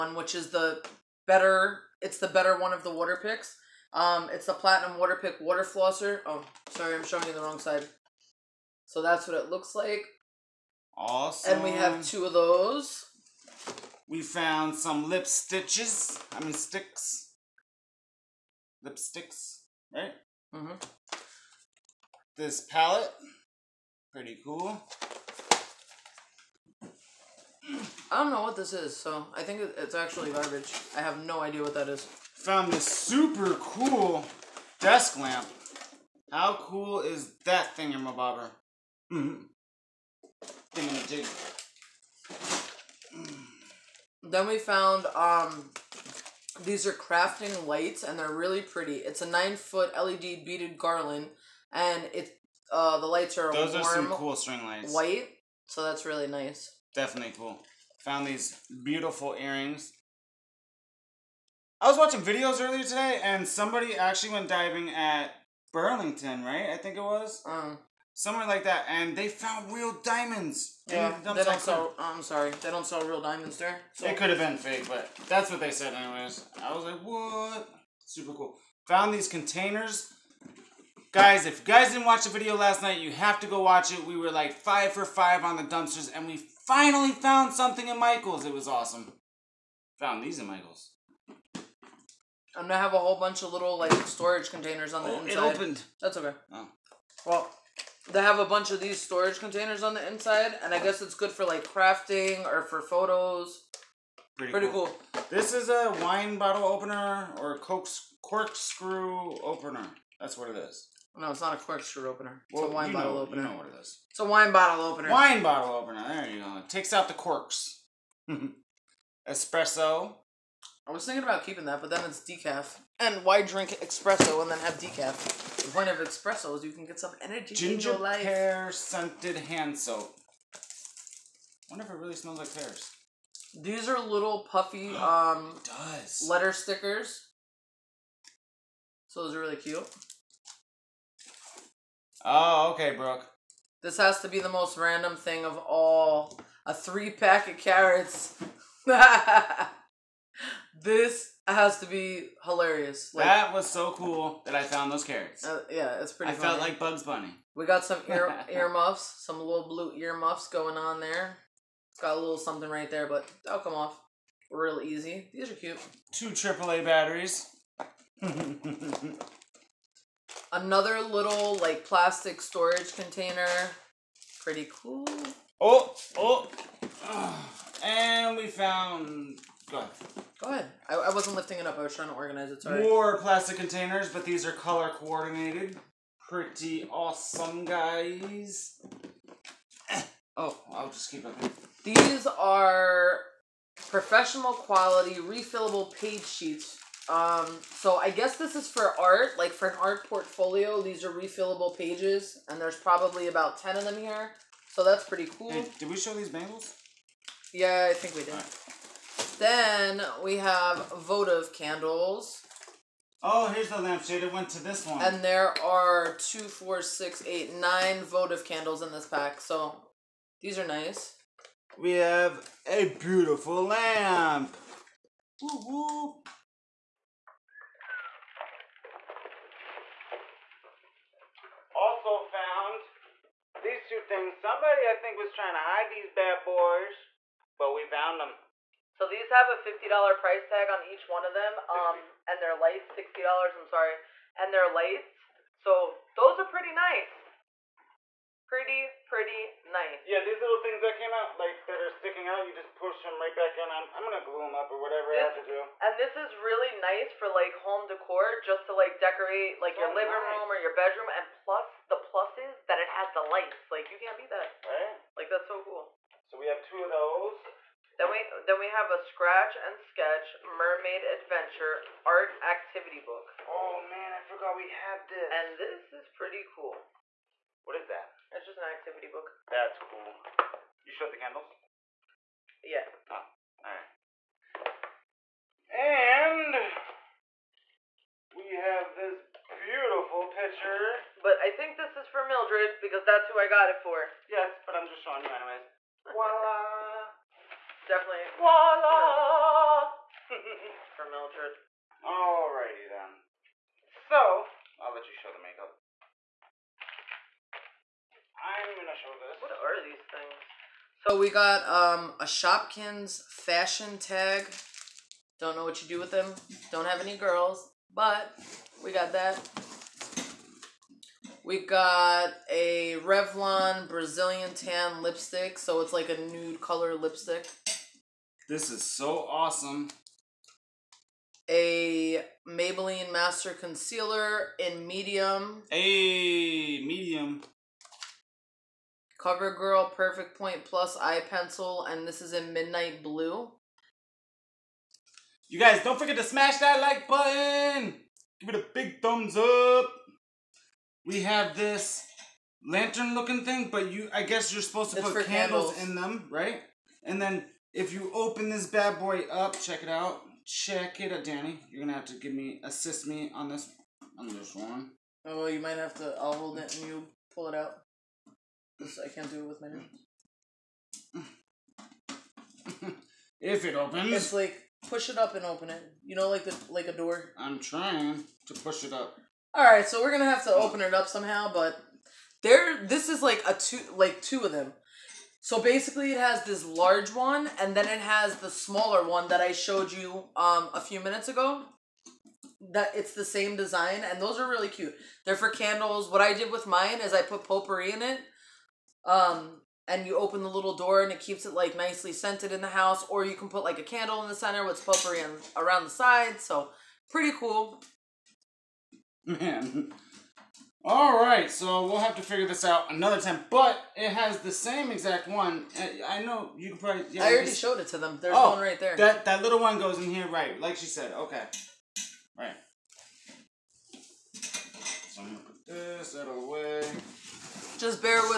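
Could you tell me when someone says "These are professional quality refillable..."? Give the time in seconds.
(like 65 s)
191 s.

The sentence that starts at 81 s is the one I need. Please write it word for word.
Guys, if you guys didn't watch the video last night, you have to go watch it.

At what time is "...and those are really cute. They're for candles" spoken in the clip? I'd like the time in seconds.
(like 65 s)
394 s.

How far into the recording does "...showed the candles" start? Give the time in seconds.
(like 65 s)
280 s.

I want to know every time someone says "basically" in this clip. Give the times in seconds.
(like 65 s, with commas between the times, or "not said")
385 s.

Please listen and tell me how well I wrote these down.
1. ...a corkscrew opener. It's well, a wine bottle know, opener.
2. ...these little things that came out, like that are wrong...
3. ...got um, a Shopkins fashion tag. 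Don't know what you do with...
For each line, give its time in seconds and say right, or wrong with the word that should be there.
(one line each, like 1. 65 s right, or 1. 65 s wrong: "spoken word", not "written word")
1. 111 s right
2. 250 s wrong: "sticking", not "wrong"
3. 311 s right.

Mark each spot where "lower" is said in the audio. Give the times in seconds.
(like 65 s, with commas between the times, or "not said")
not said.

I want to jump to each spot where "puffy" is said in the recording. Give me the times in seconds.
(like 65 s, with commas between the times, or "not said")
134 s.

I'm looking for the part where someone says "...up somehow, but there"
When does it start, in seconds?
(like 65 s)
380 s.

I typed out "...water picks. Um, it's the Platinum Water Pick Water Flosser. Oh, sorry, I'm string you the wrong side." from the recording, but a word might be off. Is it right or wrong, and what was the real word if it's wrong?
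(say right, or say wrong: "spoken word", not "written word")
wrong: "showing", not "string".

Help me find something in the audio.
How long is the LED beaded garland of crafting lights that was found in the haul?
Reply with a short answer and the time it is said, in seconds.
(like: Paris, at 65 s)
9 foot, at 49 s.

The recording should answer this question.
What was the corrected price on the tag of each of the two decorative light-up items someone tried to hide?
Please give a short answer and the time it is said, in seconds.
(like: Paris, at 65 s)
$60, at 242 s.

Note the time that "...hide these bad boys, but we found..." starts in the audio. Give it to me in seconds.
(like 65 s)
235 s.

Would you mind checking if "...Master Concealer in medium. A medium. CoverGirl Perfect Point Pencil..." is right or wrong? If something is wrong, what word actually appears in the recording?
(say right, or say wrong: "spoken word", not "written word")
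wrong: "Plus", not "Pencil".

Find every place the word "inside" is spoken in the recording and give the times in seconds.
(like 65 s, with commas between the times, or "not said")
95 s, 100 s.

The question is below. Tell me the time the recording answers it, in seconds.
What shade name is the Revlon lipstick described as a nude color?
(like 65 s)
323 s.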